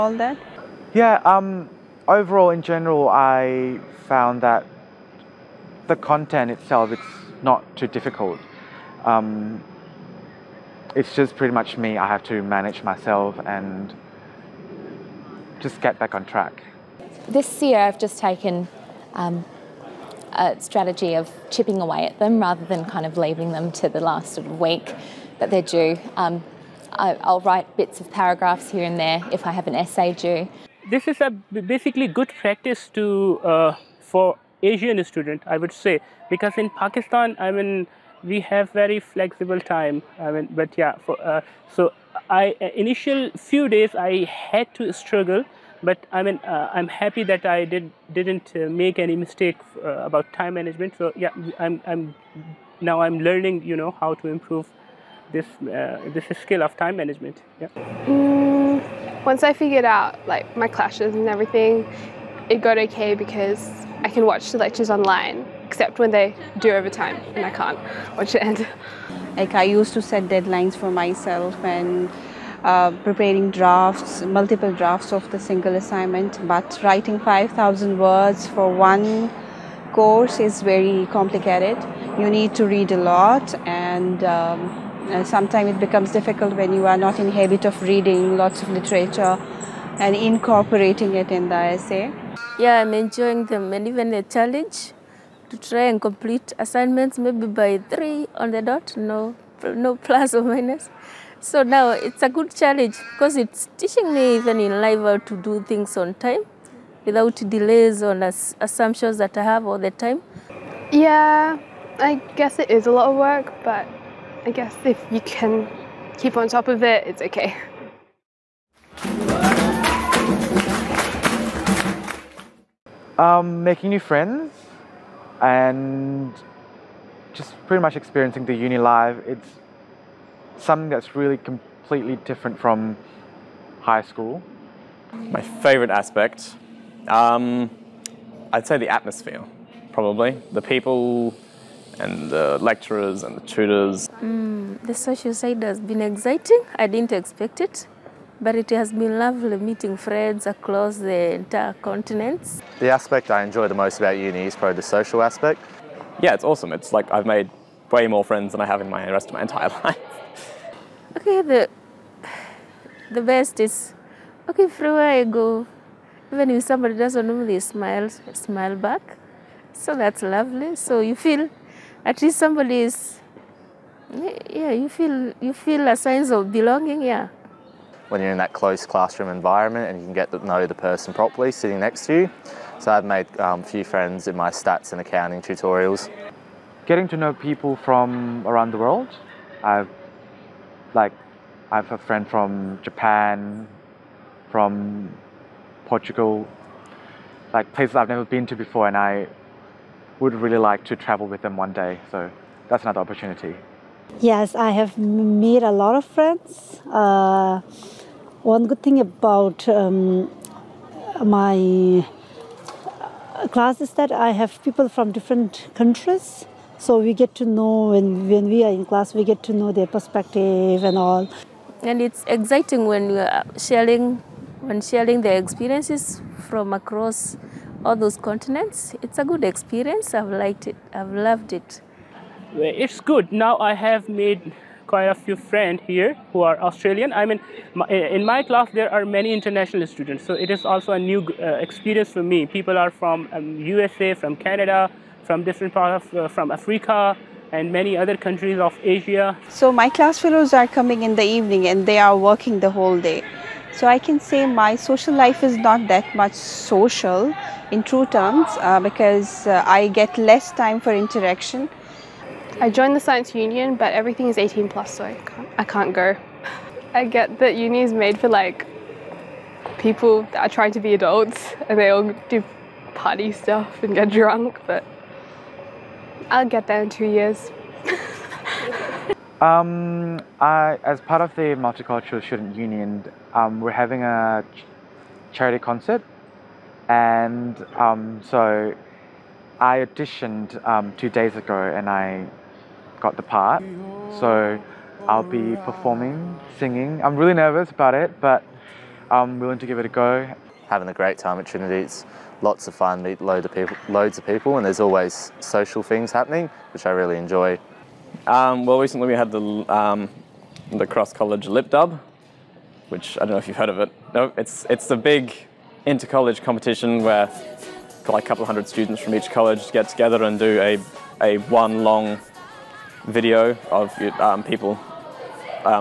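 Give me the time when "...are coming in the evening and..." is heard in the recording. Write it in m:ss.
4:10.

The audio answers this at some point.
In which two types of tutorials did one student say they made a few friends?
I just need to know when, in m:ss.
3:04.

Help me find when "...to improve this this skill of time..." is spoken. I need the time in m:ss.
0:54.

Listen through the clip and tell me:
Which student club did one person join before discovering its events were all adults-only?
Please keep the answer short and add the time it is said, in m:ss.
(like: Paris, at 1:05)
science union, at 4:22.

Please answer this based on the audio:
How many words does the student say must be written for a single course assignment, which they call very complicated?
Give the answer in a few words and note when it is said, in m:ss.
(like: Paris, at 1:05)
5,000, at 1:17.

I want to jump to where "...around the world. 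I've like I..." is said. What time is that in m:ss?
3:08.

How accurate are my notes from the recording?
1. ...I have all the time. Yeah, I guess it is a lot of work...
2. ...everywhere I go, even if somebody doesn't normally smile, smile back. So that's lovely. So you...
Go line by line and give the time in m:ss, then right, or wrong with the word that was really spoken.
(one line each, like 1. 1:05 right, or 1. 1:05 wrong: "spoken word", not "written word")
1. 1:49 right
2. 2:44 right.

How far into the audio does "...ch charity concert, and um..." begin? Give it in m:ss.
4:44.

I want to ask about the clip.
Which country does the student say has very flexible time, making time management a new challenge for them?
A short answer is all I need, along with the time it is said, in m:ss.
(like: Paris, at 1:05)
Pakistan, at 0:36.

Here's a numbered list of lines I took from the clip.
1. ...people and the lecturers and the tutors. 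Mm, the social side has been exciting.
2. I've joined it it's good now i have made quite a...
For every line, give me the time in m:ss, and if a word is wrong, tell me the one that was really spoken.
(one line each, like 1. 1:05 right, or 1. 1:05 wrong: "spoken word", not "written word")
1. 2:20 right
2. 3:50 wrong: "loved", not "joined".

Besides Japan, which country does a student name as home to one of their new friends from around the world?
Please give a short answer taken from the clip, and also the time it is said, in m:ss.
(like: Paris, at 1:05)
Portugal, at 3:15.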